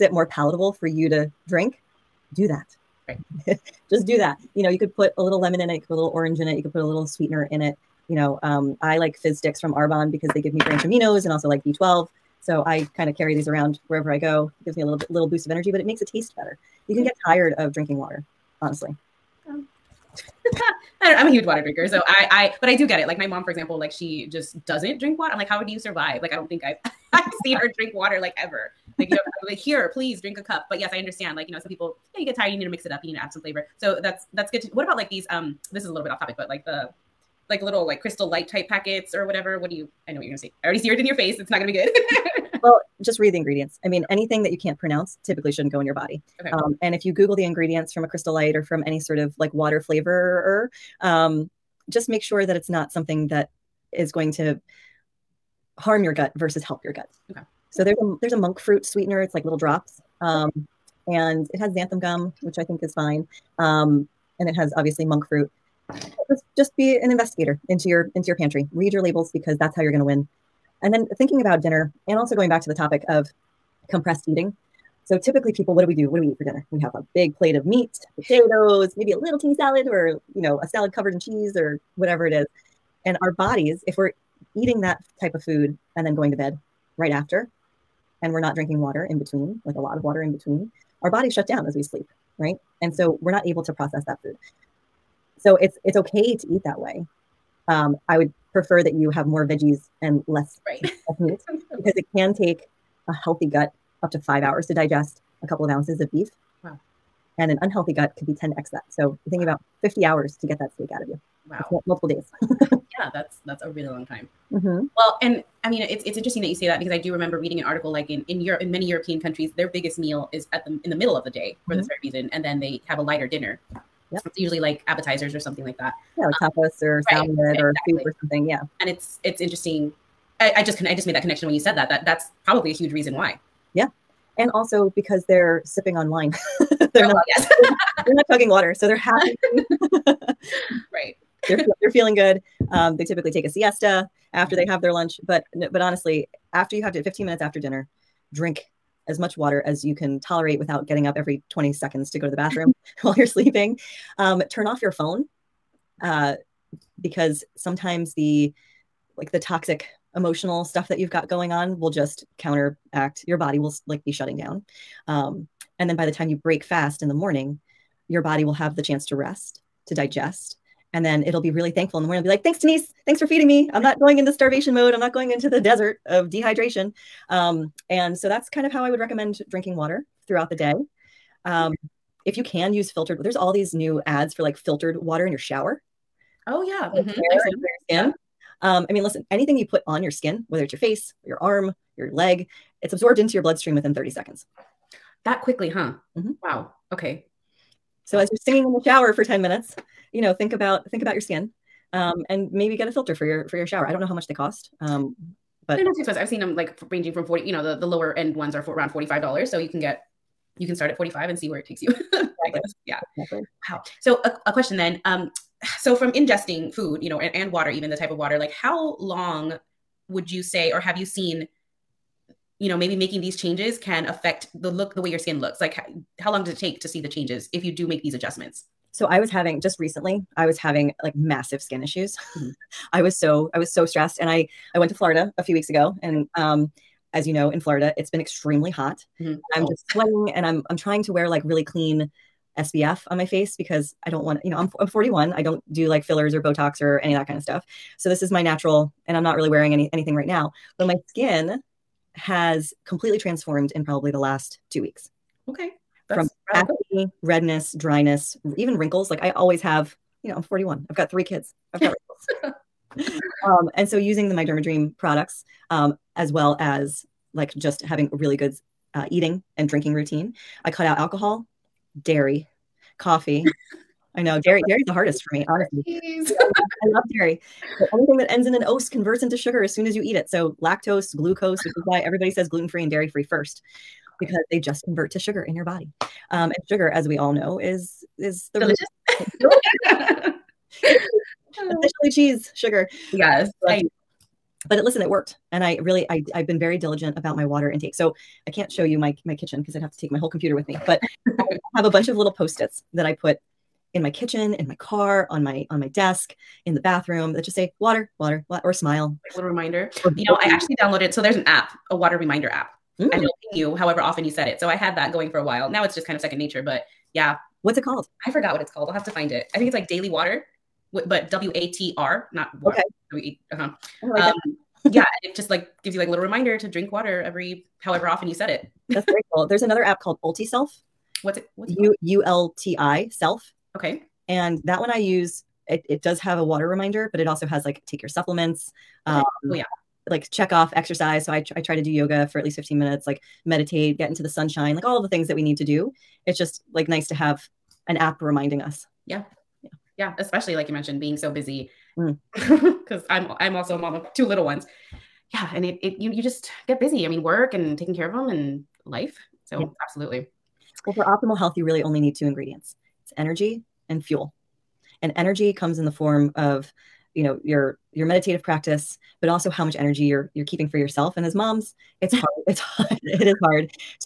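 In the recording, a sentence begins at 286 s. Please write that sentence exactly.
Um, and sugar, as we all know, is is the delicious.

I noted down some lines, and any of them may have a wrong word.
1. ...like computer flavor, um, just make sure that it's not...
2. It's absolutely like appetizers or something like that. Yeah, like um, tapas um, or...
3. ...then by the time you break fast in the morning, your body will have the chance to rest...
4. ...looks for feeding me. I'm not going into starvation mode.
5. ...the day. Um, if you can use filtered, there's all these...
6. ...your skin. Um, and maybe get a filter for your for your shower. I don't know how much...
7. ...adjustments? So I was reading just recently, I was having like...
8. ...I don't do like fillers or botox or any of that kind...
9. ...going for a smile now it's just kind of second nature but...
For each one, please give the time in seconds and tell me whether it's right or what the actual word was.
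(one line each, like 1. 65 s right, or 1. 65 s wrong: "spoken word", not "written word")
1. 49 s wrong: "water", not "computer"
2. 124 s wrong: "usually", not "absolutely"
3. 165 s right
4. 173 s wrong: "thanks", not "looks"
5. 180 s right
6. 201 s right
7. 228 s wrong: "having", not "reading"
8. 245 s right
9. 315 s wrong: "while", not "smile".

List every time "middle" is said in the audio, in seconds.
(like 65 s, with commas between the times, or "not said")
120 s.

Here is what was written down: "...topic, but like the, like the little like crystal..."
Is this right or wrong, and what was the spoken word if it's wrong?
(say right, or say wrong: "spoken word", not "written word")
right.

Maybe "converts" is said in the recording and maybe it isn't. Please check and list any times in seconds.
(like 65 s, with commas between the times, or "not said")
278 s, 284 s.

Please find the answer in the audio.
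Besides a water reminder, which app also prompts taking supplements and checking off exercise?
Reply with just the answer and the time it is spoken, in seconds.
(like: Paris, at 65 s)
UltiSelf, at 330 s.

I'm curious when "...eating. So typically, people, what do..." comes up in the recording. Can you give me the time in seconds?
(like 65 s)
74 s.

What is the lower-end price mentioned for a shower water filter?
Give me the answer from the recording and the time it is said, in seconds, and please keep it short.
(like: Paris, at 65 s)
$45, at 208 s.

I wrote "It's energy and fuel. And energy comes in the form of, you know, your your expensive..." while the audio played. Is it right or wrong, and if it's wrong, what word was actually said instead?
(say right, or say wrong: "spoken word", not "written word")
wrong: "meditative", not "expensive".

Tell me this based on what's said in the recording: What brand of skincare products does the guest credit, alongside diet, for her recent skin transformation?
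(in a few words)
My Dream.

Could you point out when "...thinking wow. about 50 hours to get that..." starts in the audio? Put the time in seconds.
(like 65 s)
109 s.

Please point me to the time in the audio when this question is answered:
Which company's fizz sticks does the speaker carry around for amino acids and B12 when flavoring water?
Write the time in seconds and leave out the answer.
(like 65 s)
9 s.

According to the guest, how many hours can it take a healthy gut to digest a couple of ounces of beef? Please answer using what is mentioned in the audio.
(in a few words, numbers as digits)
5.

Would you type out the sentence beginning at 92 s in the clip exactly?
And so we're not able to process that food.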